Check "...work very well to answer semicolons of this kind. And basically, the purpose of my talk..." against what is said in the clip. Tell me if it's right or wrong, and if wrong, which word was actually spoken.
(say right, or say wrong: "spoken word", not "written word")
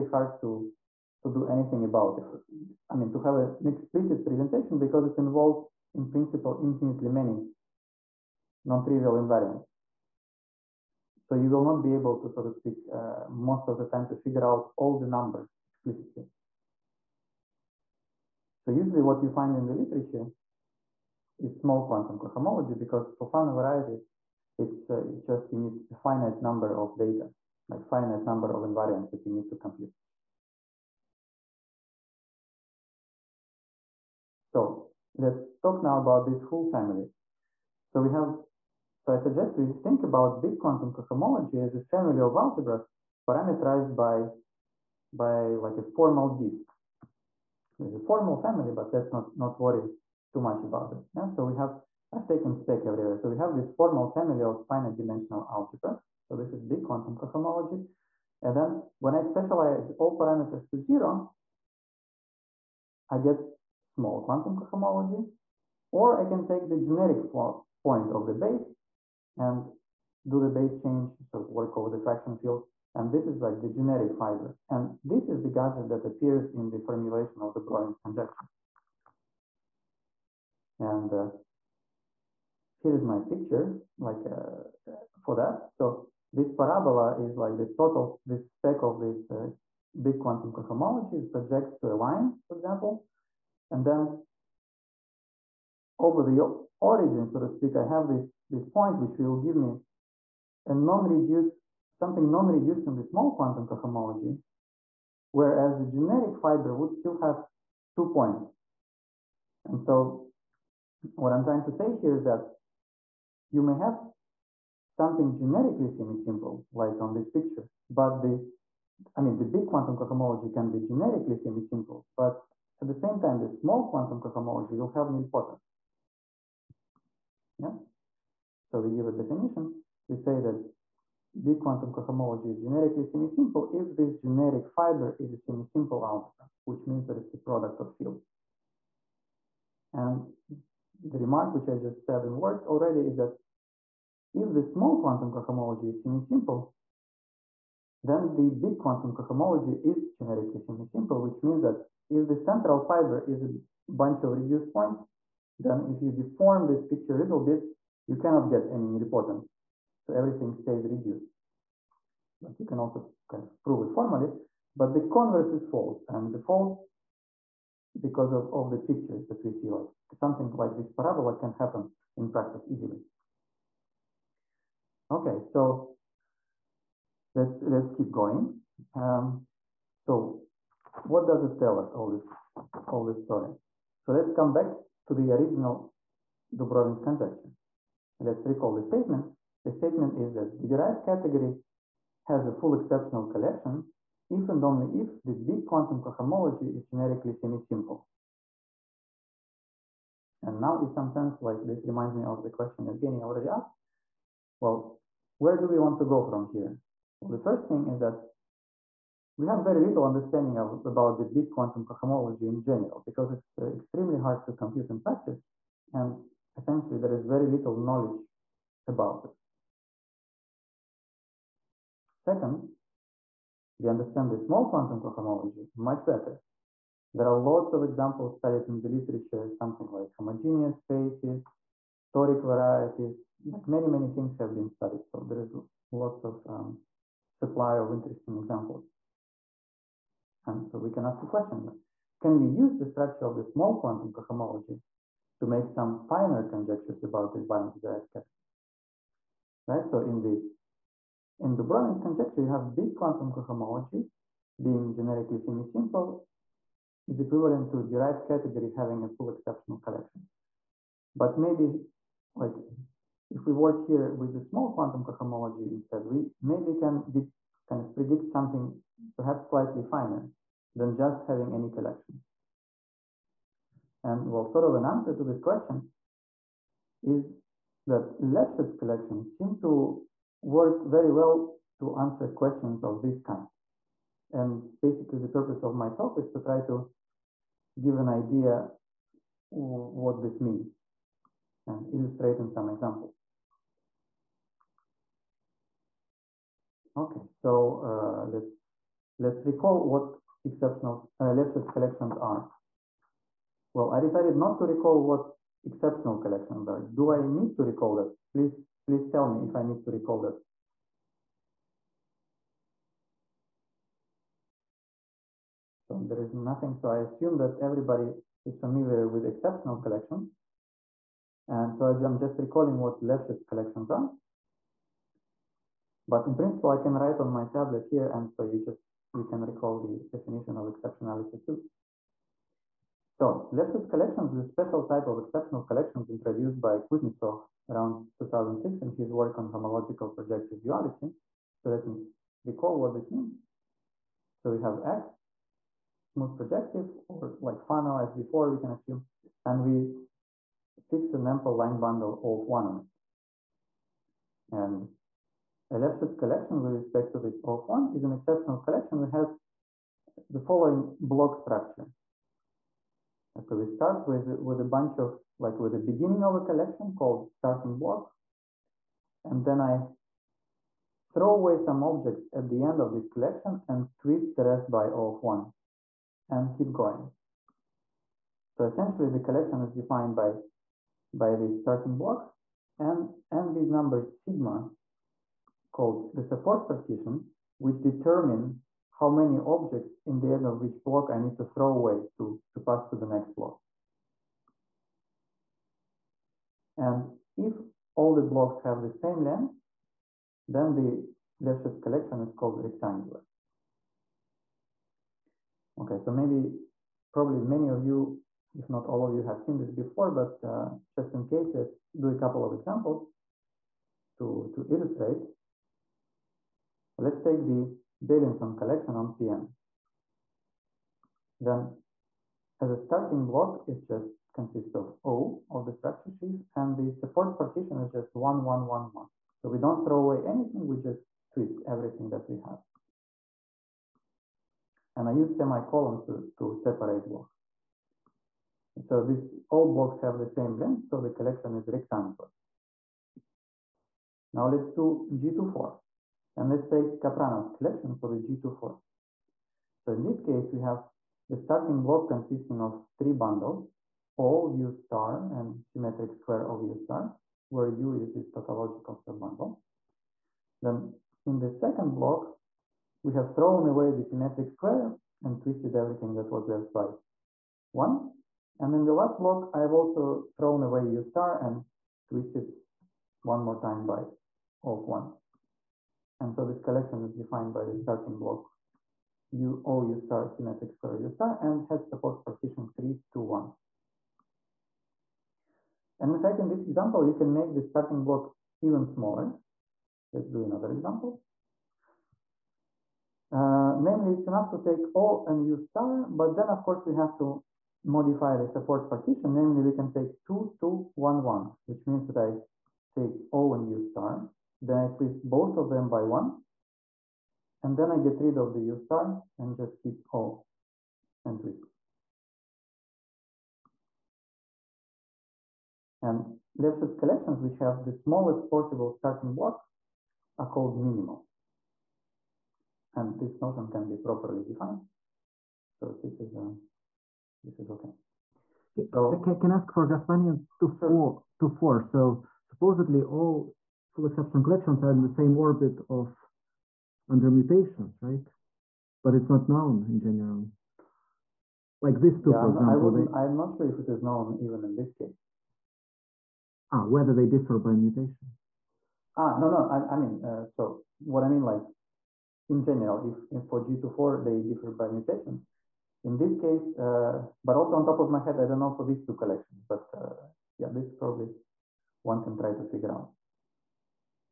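wrong: "questions", not "semicolons".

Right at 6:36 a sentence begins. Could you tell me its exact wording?
And if all the blocks have the same length, then the Lefschetz collection is called rectangular.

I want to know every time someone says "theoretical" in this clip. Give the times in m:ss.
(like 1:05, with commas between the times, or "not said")
not said.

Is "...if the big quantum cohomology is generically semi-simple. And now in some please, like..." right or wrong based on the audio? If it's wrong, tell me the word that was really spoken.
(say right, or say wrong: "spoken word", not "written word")
wrong: "sense", not "please".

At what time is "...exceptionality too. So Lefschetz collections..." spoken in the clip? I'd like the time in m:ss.
5:30.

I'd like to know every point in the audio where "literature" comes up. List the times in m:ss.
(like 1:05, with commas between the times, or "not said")
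0:19, 3:48.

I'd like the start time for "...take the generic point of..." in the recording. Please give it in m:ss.
1:06.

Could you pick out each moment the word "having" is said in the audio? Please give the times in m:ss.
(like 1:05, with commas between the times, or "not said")
4:18, 4:31.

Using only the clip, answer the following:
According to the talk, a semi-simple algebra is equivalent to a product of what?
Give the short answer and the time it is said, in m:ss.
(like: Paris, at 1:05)
Fields, at 2:17.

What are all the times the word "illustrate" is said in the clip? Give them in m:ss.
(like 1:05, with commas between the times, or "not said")
4:51, 6:54.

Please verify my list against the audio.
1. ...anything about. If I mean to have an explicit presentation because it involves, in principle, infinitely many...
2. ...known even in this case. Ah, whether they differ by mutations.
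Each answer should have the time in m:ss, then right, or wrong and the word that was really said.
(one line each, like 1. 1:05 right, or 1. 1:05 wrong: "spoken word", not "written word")
1. 0:01 right
2. 9:04 right.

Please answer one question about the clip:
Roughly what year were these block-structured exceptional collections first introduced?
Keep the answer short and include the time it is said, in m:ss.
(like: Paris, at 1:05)
2006, at 5:38.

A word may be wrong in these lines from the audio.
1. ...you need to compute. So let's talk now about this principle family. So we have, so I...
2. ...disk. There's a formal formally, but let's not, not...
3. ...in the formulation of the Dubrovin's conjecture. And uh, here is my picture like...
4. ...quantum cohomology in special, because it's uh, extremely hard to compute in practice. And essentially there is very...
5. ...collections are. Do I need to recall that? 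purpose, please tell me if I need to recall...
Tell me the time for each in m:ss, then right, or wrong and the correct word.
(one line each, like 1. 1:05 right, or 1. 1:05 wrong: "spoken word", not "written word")
1. 0:29 wrong: "whole", not "principle"
2. 0:46 wrong: "family", not "formally"
3. 1:16 right
4. 3:31 wrong: "general", not "special"
5. 5:06 wrong: "please", not "purpose".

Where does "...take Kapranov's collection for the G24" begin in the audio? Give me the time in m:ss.
7:26.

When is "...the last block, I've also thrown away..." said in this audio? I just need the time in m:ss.
7:48.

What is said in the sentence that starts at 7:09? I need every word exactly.
So we don't throw away anything, we just twist everything that we have.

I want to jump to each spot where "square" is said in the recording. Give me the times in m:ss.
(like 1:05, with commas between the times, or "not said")
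7:36, 7:44, 8:00.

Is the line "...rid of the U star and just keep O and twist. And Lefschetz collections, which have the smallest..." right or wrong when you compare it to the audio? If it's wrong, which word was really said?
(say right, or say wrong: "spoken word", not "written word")
right.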